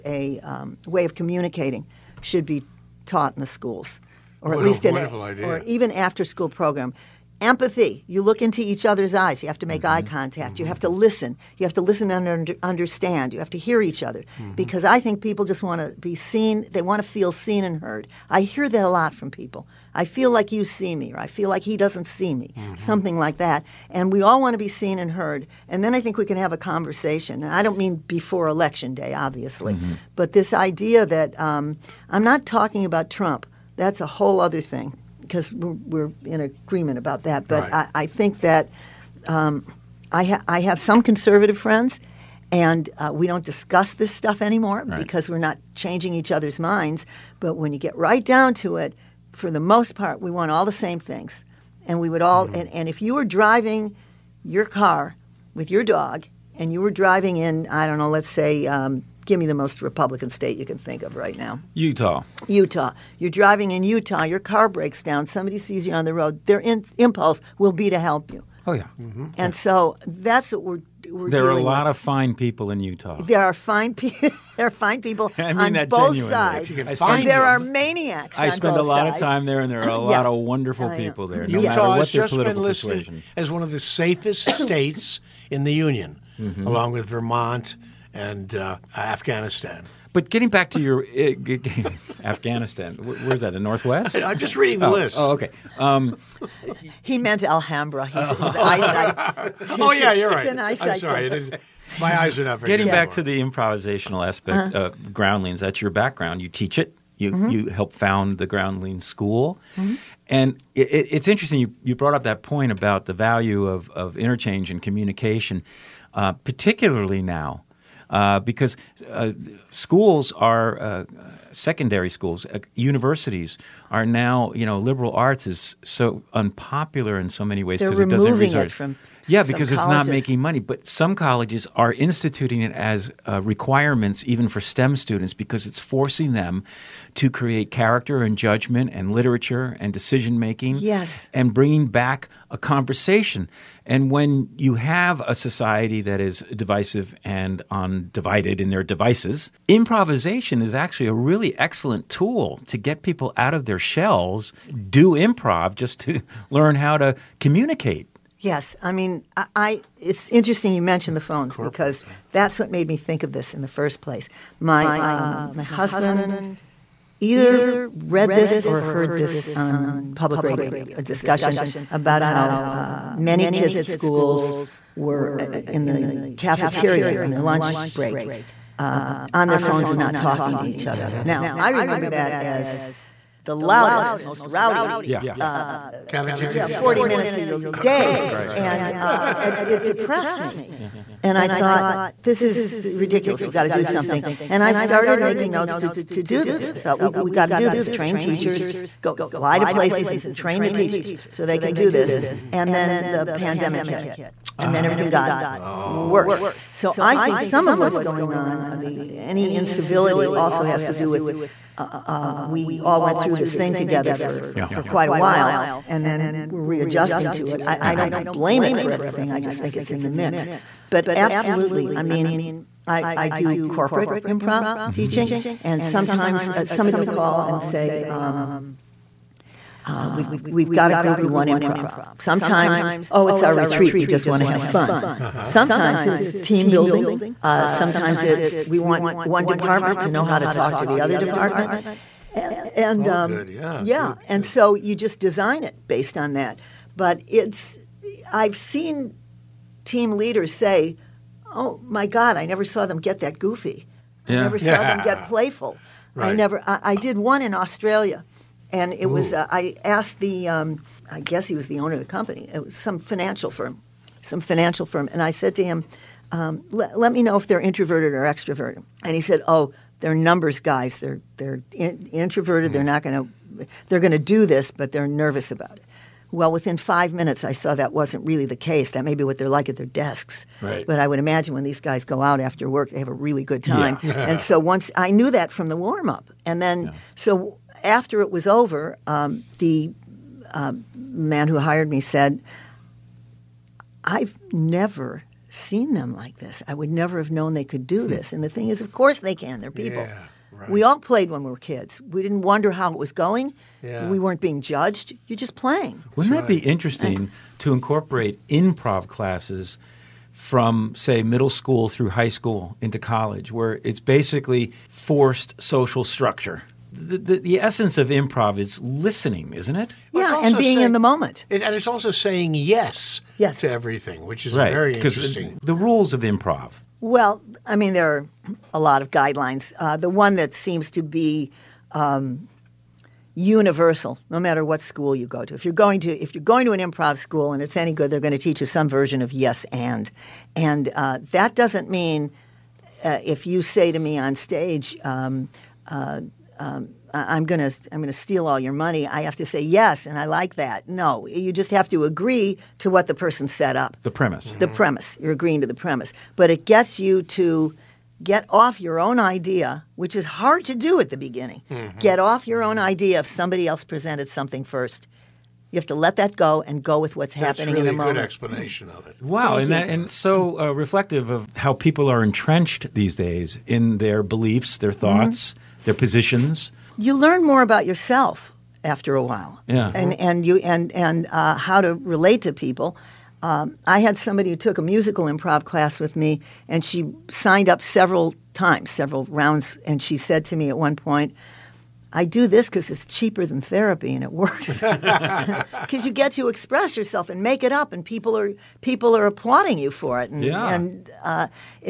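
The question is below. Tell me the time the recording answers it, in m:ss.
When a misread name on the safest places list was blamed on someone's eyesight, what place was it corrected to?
1:37.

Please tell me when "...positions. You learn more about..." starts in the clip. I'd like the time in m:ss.
6:15.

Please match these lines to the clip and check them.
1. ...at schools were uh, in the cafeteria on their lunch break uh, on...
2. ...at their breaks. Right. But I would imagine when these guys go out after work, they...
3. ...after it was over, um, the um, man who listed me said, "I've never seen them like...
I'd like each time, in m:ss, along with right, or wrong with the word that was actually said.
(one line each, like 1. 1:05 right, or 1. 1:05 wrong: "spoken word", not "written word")
1. 2:53 right
2. 4:39 wrong: "desks", not "breaks"
3. 4:47 wrong: "hired", not "listed".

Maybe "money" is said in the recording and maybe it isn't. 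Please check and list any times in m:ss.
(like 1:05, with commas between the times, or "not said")
2:10, 5:48.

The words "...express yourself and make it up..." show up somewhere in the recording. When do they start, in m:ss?
6:36.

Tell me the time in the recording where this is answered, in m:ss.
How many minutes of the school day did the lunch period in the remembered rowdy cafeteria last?
3:06.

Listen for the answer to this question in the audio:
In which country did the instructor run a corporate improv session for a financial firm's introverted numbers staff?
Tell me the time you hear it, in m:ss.
4:17.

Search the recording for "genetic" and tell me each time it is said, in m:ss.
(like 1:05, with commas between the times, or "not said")
not said.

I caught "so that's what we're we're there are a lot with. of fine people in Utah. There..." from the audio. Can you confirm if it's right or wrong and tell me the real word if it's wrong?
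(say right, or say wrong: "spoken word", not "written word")
right.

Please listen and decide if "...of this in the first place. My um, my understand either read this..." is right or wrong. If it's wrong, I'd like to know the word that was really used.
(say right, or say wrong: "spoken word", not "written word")
wrong: "husband", not "understand".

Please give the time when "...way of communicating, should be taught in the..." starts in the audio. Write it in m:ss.
0:00.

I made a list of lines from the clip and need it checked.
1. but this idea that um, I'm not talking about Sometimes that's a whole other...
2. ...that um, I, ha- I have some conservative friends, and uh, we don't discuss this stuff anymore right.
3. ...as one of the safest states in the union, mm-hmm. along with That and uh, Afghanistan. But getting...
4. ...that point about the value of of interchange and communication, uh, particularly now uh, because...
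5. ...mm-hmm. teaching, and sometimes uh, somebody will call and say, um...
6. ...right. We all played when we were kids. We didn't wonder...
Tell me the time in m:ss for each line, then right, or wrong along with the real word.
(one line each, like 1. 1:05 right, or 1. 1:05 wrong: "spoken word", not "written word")
1. 0:30 wrong: "Trump", not "Sometimes"
2. 0:38 right
3. 1:23 wrong: "Vermont", not "That"
4. 1:52 right
5. 3:44 right
6. 5:00 right.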